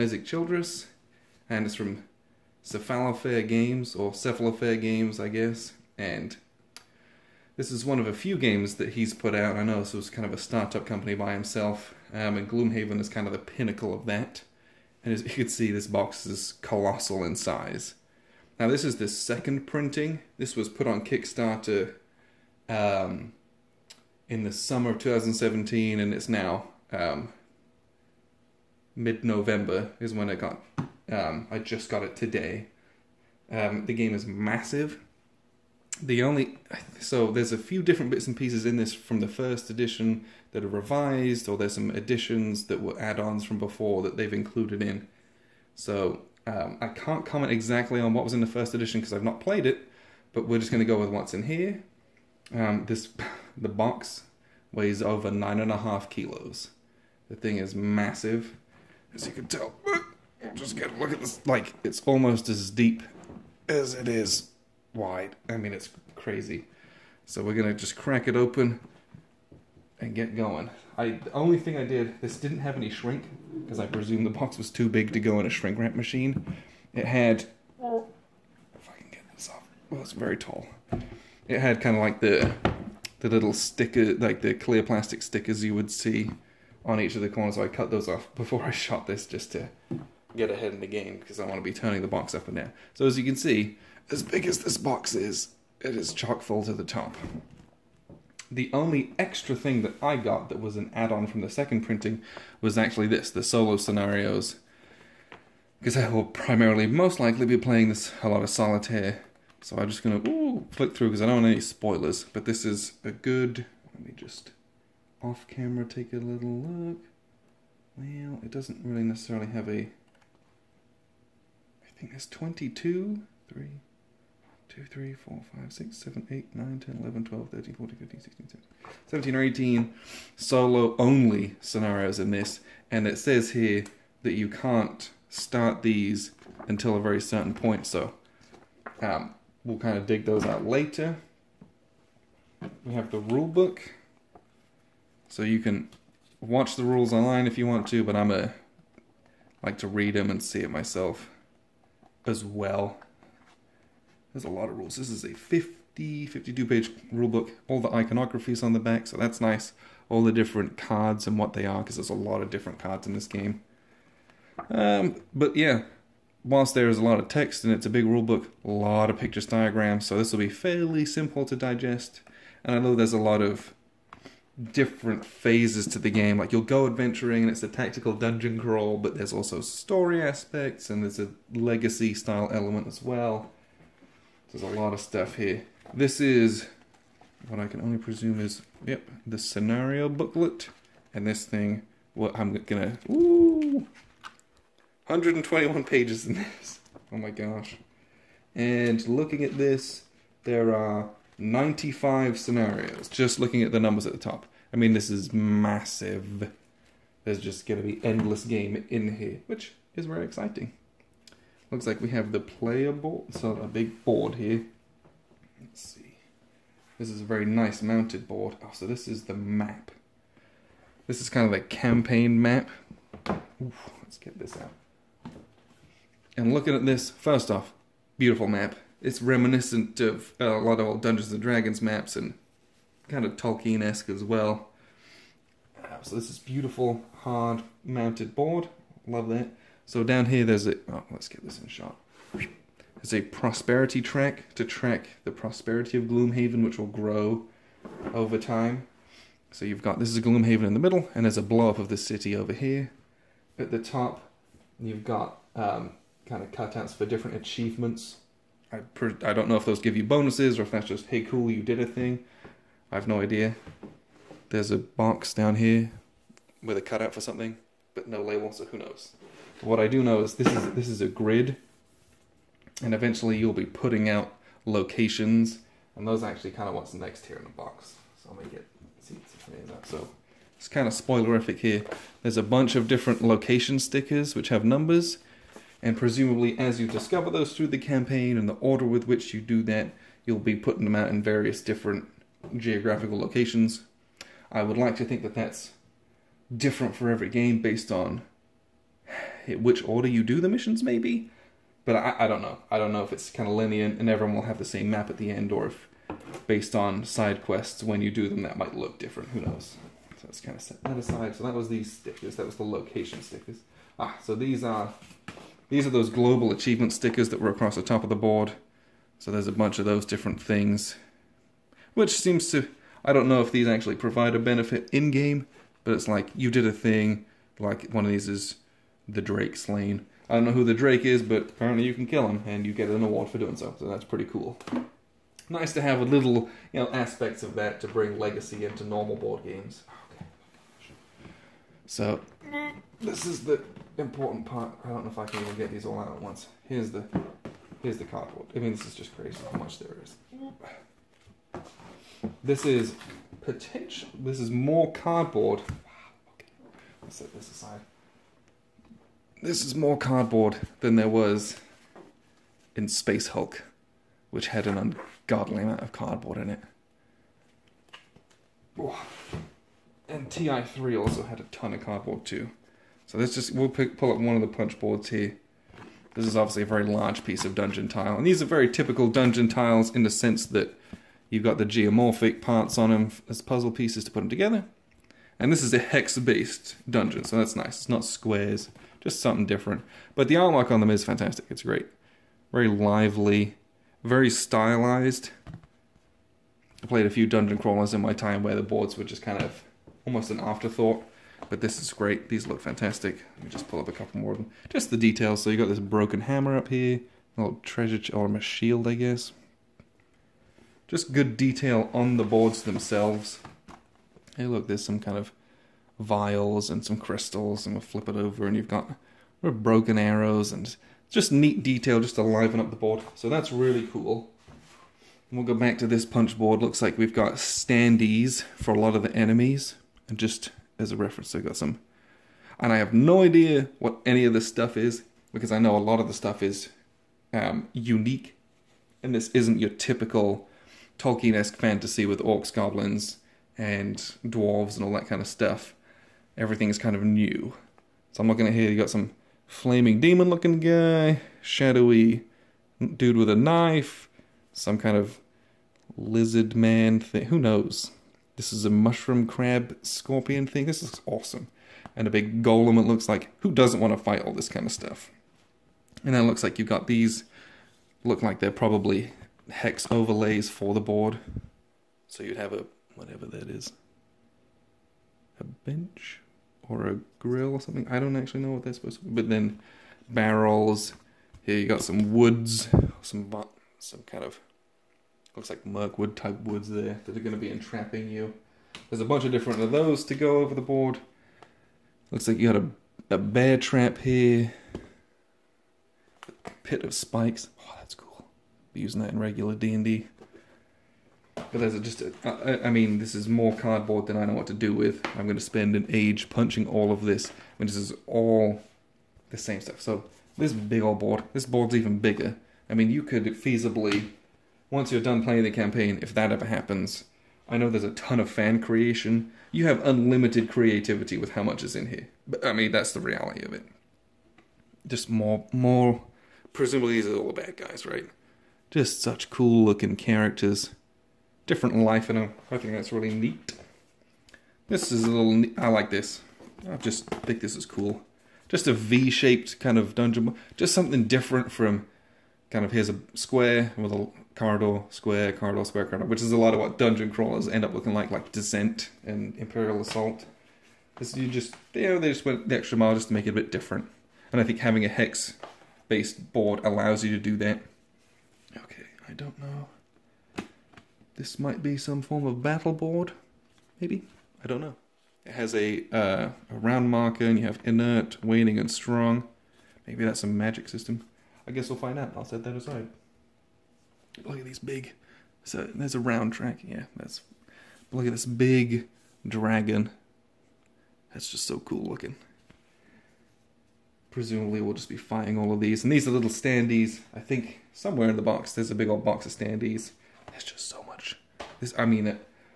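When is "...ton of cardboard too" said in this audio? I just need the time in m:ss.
6:11.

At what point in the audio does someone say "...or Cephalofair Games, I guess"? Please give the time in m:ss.
0:03.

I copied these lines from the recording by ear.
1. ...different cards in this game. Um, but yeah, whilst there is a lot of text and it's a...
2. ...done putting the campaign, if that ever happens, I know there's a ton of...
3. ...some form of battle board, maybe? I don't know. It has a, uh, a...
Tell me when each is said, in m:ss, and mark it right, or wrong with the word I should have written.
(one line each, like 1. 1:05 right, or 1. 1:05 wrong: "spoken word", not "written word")
1. 2:42 right
2. 8:35 wrong: "playing", not "putting"
3. 9:21 right.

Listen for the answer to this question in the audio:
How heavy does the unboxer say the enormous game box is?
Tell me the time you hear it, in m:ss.
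0:55.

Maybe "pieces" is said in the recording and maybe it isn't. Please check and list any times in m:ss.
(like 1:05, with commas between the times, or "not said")
0:38, 6:17, 6:23.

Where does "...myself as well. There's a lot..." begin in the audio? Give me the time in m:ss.
2:30.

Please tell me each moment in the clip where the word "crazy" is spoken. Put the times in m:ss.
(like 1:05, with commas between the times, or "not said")
1:06, 5:49.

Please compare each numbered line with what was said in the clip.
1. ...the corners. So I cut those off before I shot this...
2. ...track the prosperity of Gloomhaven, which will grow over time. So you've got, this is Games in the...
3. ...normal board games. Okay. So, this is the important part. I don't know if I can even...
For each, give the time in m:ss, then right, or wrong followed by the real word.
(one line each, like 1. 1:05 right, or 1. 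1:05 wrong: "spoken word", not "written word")
1. 1:27 right
2. 4:04 wrong: "Gloomhaven", not "Games"
3. 5:38 right.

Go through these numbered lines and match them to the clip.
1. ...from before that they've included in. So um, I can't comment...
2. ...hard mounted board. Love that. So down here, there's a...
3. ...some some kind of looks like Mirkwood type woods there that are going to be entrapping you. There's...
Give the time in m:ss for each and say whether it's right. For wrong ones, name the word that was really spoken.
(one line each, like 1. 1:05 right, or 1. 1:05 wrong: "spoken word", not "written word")
1. 0:43 right
2. 3:57 right
3. 8:03 right.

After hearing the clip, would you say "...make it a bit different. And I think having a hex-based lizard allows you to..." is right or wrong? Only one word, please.
wrong.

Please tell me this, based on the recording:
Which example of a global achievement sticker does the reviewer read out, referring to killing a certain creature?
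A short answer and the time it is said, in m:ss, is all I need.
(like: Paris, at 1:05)
The Drake slain, at 5:29.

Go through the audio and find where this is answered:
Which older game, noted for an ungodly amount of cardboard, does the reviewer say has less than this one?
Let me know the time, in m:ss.
6:02.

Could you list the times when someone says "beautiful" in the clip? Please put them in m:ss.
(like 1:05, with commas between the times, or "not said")
3:48, 3:56.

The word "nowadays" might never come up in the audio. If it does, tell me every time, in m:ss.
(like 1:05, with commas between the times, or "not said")
not said.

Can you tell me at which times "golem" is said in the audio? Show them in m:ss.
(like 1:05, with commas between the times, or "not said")
7:42.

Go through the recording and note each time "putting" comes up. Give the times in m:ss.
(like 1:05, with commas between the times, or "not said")
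4:33, 4:50.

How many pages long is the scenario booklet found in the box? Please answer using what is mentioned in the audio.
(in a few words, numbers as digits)
121.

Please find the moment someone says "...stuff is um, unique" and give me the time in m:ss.
7:16.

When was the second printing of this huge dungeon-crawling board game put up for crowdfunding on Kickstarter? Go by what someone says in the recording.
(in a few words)
Summer of 2017.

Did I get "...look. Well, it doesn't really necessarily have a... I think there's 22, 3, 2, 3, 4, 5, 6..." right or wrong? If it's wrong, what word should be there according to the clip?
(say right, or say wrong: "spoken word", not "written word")
right.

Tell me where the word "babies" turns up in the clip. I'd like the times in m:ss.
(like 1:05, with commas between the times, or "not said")
not said.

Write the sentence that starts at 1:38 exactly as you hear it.
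The only extra thing that I got that was an add-on from the second printing was actually this, the solo scenarios.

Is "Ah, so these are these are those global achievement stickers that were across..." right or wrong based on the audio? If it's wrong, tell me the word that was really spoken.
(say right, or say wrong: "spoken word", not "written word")
right.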